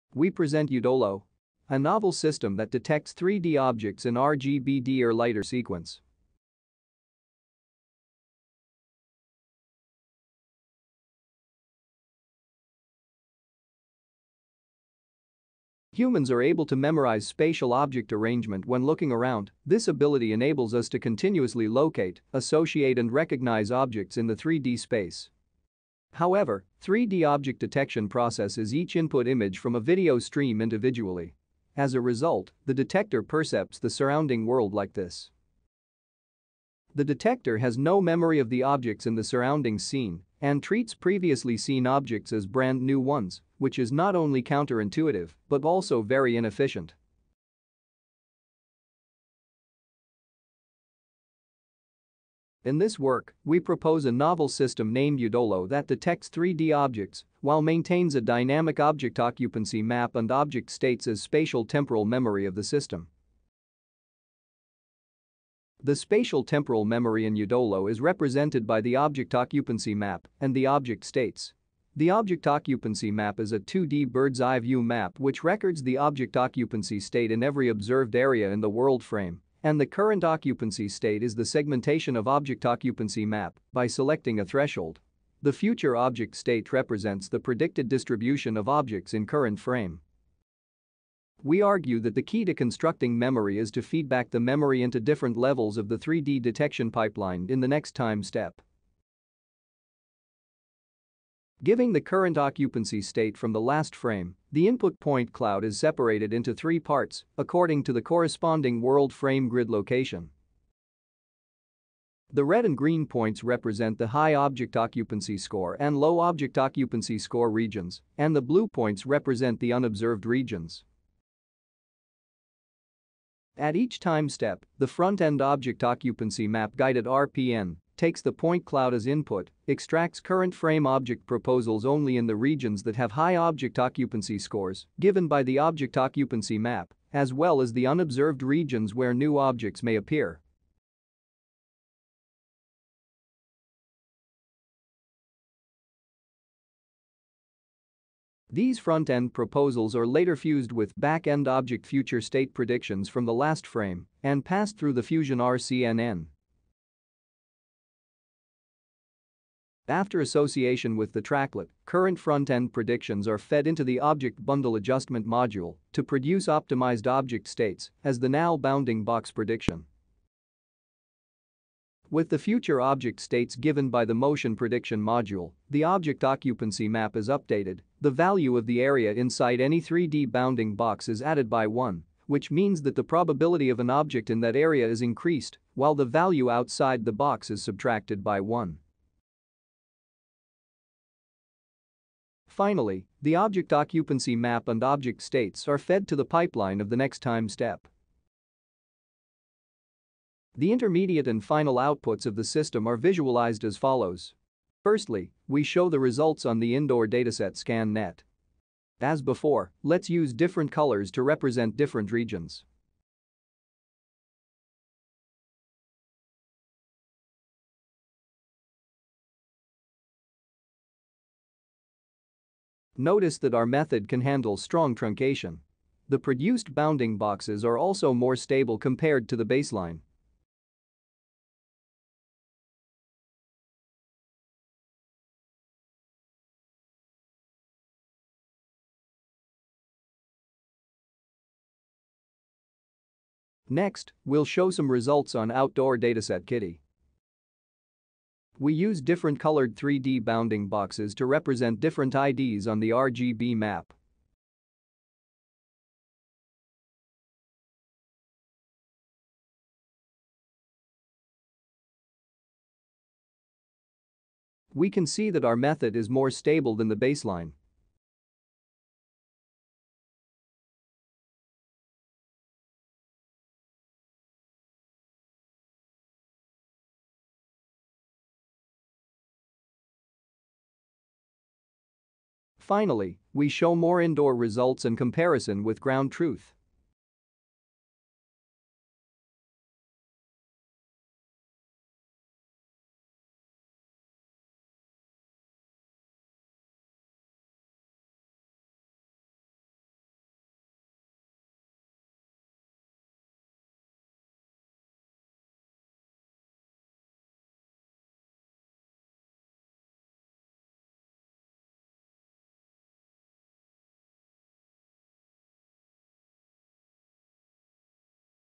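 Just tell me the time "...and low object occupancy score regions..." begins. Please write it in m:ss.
1:55.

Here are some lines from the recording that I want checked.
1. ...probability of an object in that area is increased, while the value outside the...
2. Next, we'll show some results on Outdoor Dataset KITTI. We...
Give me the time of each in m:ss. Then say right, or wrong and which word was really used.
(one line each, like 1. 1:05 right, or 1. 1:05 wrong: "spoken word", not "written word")
1. 3:03 right
2. 4:03 right.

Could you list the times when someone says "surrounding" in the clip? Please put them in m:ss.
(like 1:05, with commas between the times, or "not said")
0:33, 0:39.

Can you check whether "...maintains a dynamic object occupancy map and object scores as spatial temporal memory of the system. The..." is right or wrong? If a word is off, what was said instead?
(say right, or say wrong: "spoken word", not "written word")
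wrong: "states", not "scores".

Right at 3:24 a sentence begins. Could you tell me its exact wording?
Firstly, we show the results on the indoor dataset ScanNet.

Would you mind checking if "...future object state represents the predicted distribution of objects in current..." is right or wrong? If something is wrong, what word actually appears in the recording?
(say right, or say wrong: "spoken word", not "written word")
right.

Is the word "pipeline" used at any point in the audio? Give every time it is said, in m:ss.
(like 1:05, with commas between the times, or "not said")
1:36, 3:16.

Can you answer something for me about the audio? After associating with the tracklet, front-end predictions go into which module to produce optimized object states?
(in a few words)
Object Bundle Adjustment.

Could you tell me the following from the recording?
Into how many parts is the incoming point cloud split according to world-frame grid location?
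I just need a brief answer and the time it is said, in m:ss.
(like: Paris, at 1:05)
3, at 1:46.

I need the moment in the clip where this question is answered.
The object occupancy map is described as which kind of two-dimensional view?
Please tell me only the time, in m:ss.
1:14.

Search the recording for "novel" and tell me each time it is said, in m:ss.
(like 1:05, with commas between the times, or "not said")
0:01, 0:54.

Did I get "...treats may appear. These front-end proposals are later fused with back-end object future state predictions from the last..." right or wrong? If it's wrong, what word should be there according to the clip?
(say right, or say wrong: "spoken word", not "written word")
wrong: "objects", not "treats".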